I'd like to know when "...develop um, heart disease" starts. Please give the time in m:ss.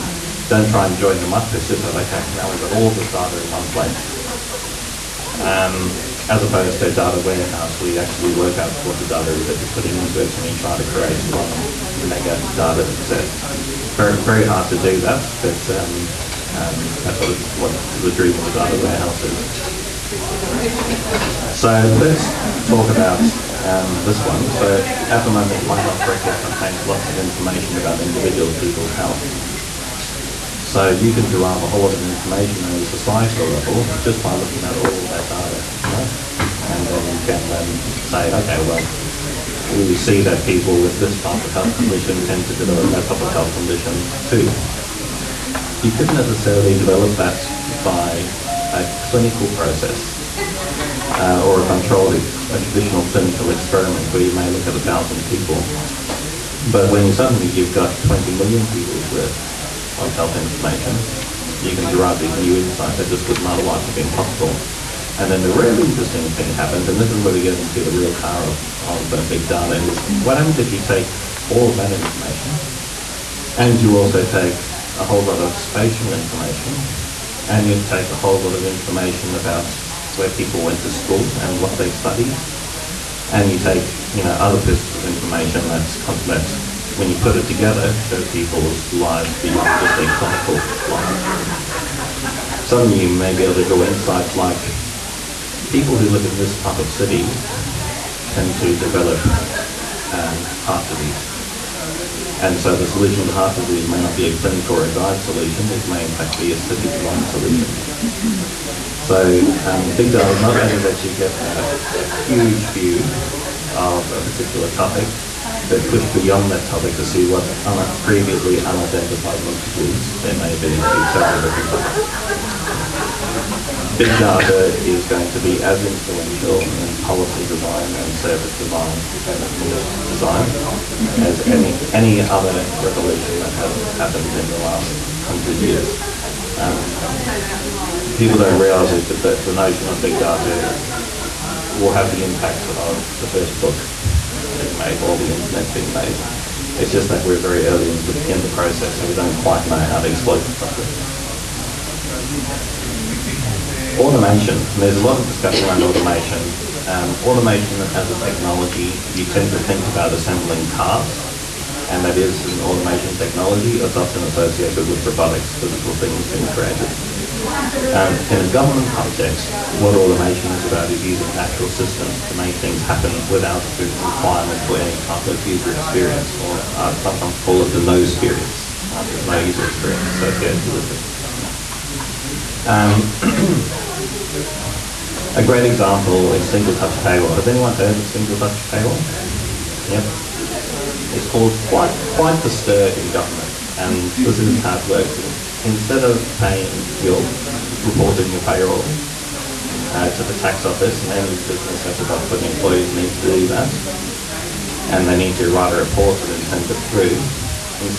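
1:38.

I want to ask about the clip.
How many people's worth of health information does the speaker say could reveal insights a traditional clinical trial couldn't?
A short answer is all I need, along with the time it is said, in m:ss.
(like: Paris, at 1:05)
20 million, at 0:58.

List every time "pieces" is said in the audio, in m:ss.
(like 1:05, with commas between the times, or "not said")
1:24.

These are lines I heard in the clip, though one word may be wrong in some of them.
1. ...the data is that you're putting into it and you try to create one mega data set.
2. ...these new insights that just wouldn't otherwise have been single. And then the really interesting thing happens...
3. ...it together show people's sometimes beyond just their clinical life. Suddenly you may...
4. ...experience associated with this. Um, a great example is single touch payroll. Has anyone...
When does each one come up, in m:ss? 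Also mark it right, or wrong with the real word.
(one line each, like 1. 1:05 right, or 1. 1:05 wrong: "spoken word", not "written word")
1. 0:08 right
2. 1:02 wrong: "possible", not "single"
3. 1:27 wrong: "lives", not "sometimes"
4. 2:59 right.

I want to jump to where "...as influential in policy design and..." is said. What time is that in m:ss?
2:05.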